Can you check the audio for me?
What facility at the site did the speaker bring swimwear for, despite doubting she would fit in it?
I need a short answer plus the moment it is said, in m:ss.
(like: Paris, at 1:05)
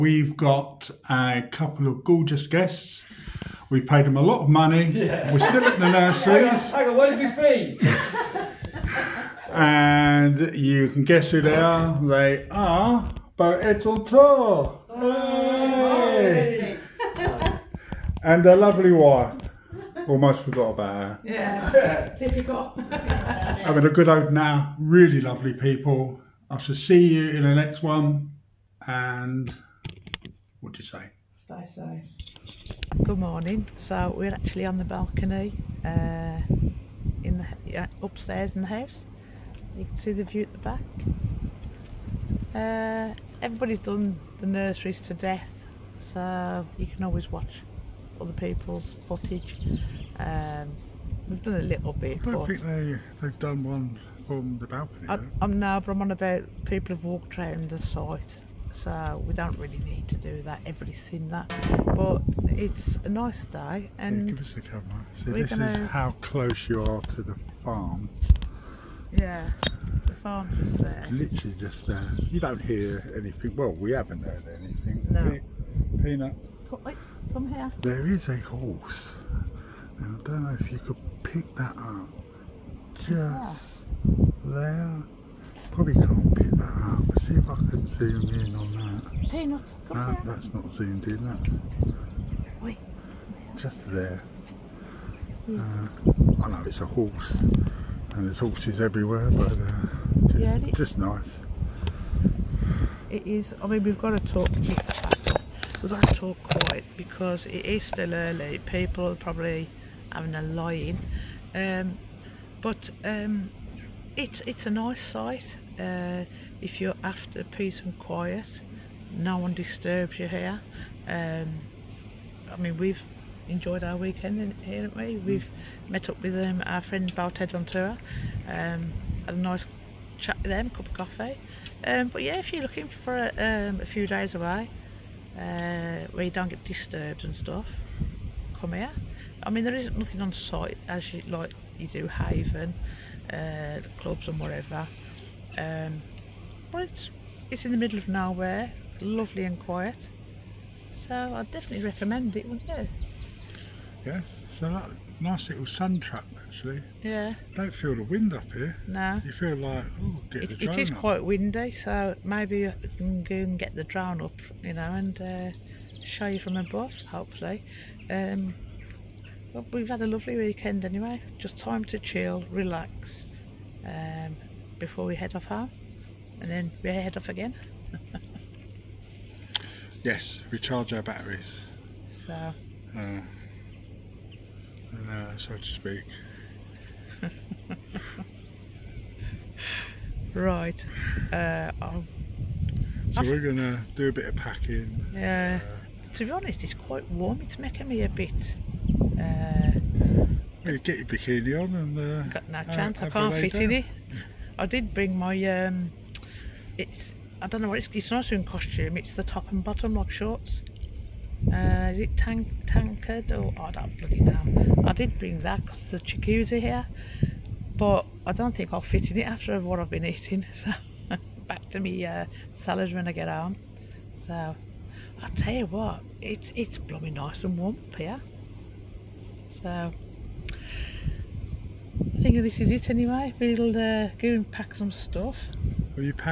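Jacuzzi, at 3:35.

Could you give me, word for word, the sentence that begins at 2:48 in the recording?
Um, but we've had a lovely weekend anyway.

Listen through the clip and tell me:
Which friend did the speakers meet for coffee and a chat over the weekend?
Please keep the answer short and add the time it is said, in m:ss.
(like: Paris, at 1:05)
Balted Ventura, at 2:07.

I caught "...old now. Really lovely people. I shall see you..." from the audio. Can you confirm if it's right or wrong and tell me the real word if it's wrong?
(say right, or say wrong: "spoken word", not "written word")
right.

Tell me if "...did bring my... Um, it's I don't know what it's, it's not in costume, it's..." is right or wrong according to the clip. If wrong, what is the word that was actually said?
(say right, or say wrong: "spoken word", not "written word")
right.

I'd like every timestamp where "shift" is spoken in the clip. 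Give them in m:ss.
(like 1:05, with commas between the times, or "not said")
not said.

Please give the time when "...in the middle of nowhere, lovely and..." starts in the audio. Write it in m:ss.
2:27.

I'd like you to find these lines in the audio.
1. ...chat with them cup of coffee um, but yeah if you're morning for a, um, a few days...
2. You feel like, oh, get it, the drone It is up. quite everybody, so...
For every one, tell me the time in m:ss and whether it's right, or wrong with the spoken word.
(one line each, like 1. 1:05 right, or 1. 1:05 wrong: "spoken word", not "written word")
1. 2:10 wrong: "looking", not "morning"
2. 2:39 wrong: "windy", not "everybody".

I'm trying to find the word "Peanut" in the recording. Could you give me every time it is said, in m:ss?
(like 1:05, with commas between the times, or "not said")
1:16, 1:29.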